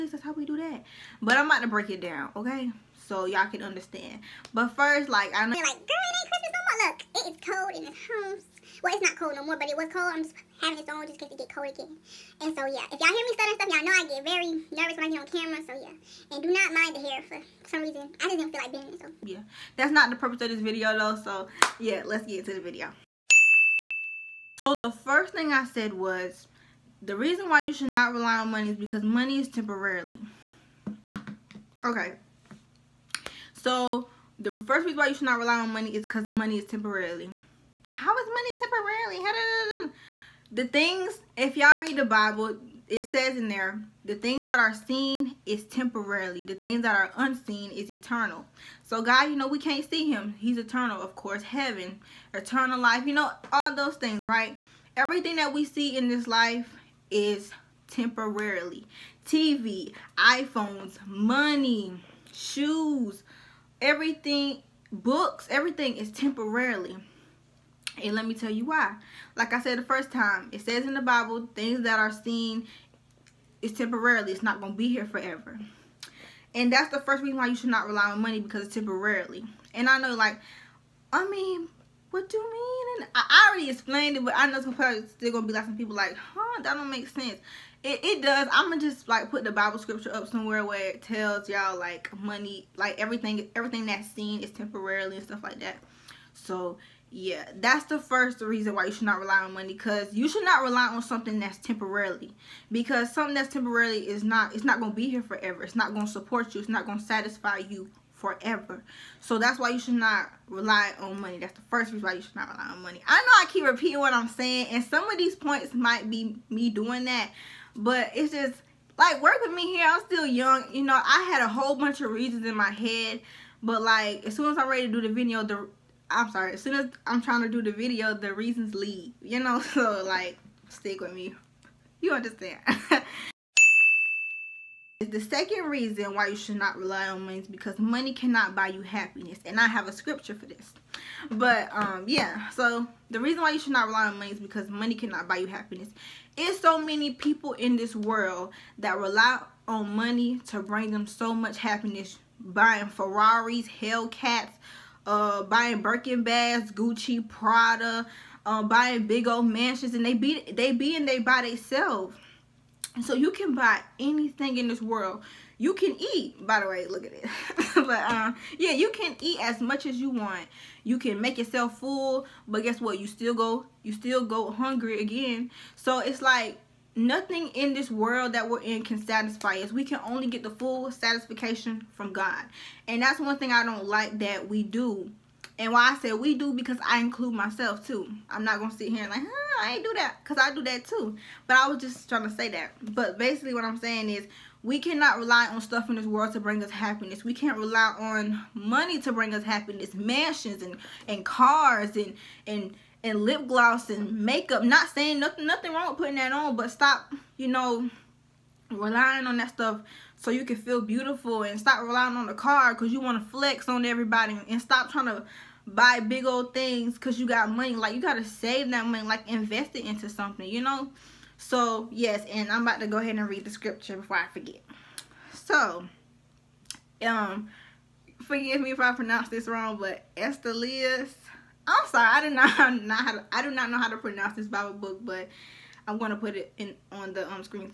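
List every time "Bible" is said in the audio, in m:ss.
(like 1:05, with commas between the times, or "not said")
0:42, 1:11, 1:29, 3:54.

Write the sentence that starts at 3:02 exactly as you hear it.
And that's one thing I don't like that we do.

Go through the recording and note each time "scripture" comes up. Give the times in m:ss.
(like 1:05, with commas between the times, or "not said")
1:29, 2:19, 3:43.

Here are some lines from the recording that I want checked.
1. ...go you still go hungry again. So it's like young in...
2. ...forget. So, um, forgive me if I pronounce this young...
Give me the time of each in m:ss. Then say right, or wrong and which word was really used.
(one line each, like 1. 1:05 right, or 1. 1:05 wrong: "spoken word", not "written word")
1. 2:53 wrong: "nothing", not "young"
2. 3:44 wrong: "wrong", not "young".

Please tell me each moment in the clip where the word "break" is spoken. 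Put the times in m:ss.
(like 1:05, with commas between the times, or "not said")
0:01.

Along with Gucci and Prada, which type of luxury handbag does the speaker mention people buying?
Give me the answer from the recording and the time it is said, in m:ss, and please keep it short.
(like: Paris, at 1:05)
Birkin bags, at 2:35.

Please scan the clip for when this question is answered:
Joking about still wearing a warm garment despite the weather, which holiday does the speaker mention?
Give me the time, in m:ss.
0:06.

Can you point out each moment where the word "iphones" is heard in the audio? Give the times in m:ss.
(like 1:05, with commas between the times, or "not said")
1:00.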